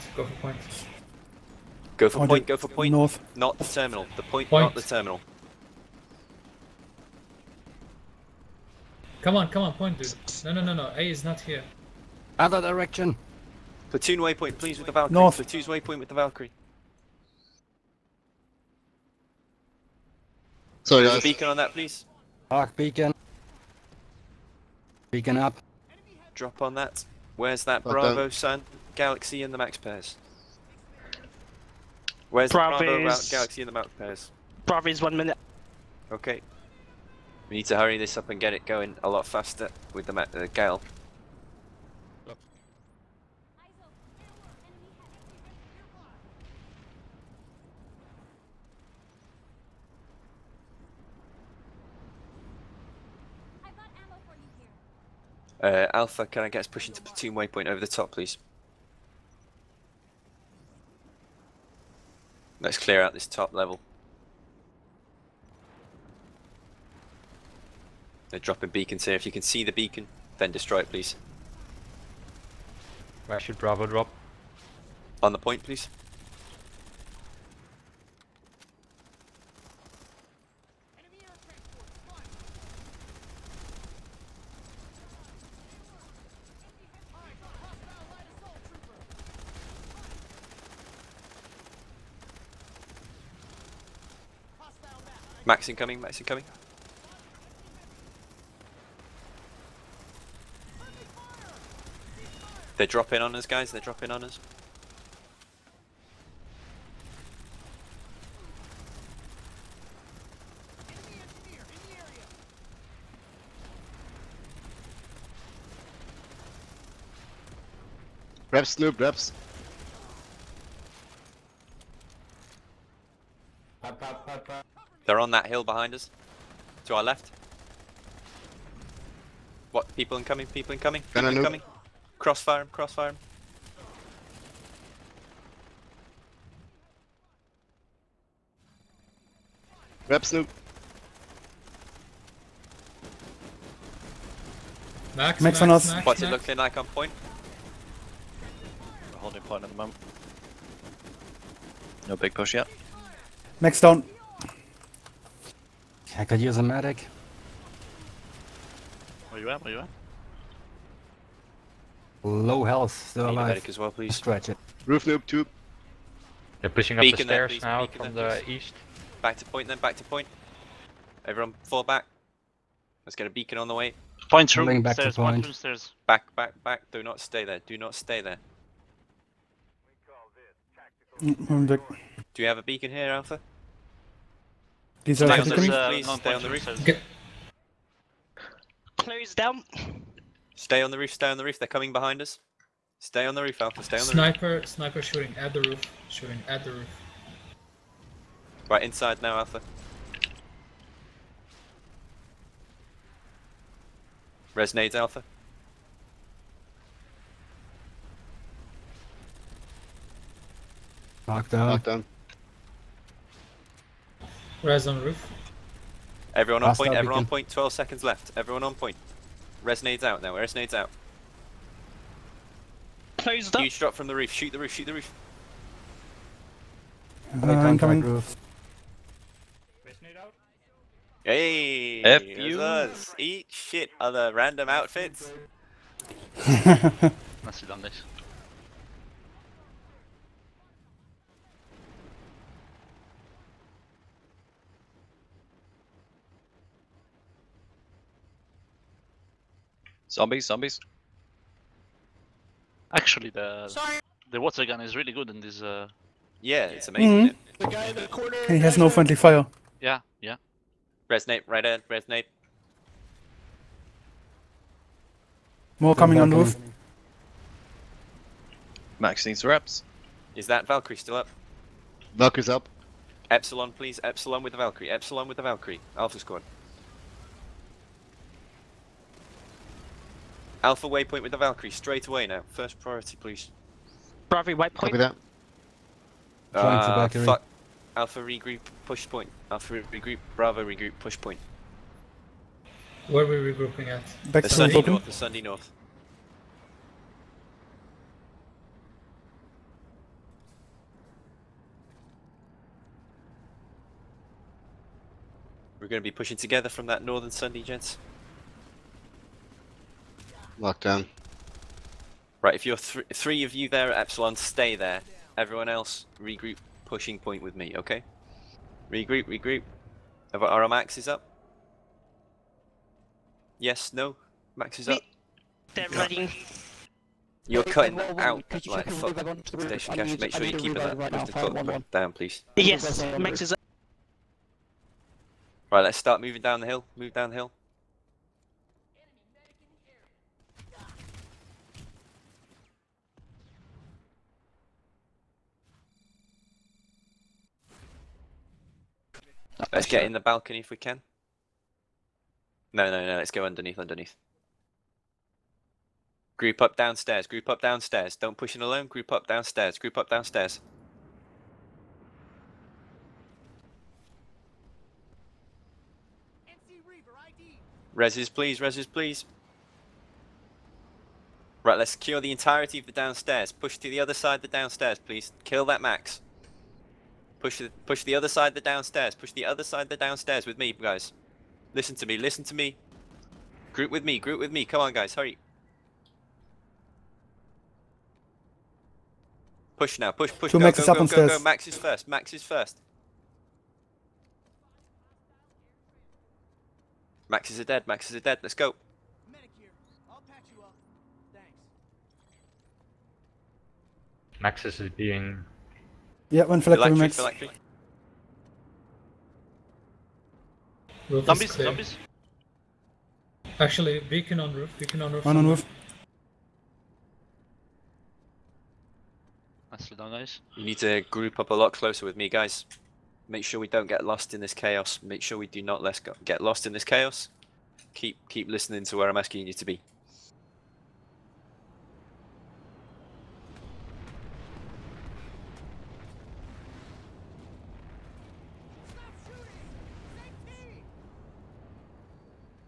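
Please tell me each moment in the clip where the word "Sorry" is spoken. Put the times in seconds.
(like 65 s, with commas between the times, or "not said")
20 s, 253 s.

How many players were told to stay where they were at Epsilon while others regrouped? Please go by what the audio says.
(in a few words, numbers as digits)
3.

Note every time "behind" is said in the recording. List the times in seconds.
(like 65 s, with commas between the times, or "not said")
125 s, 191 s.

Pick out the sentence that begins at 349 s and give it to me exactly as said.
Let's get in the balcony if we can.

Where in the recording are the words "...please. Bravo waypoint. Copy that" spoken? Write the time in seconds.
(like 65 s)
283 s.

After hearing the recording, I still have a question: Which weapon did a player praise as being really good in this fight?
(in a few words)
water gun.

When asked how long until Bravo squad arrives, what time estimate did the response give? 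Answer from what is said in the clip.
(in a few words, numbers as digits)
1 minute.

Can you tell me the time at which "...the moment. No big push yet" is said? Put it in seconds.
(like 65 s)
149 s.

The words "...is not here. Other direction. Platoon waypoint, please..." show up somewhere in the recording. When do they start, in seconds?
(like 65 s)
11 s.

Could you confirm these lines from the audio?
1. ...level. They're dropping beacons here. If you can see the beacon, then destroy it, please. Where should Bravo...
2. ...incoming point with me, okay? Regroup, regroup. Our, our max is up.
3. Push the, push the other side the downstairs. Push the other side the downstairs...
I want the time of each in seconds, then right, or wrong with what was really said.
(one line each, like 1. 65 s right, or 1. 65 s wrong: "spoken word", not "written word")
1. 63 s right
2. 316 s wrong: "pushing", not "incoming"
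3. 377 s right.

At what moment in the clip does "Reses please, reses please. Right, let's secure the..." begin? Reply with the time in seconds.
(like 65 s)
367 s.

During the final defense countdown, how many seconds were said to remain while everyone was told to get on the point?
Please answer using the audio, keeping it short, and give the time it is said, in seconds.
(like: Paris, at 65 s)
12, at 217 s.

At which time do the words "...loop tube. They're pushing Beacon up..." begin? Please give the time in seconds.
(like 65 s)
165 s.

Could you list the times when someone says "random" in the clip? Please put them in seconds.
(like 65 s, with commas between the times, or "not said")
234 s.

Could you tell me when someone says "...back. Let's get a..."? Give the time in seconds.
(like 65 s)
171 s.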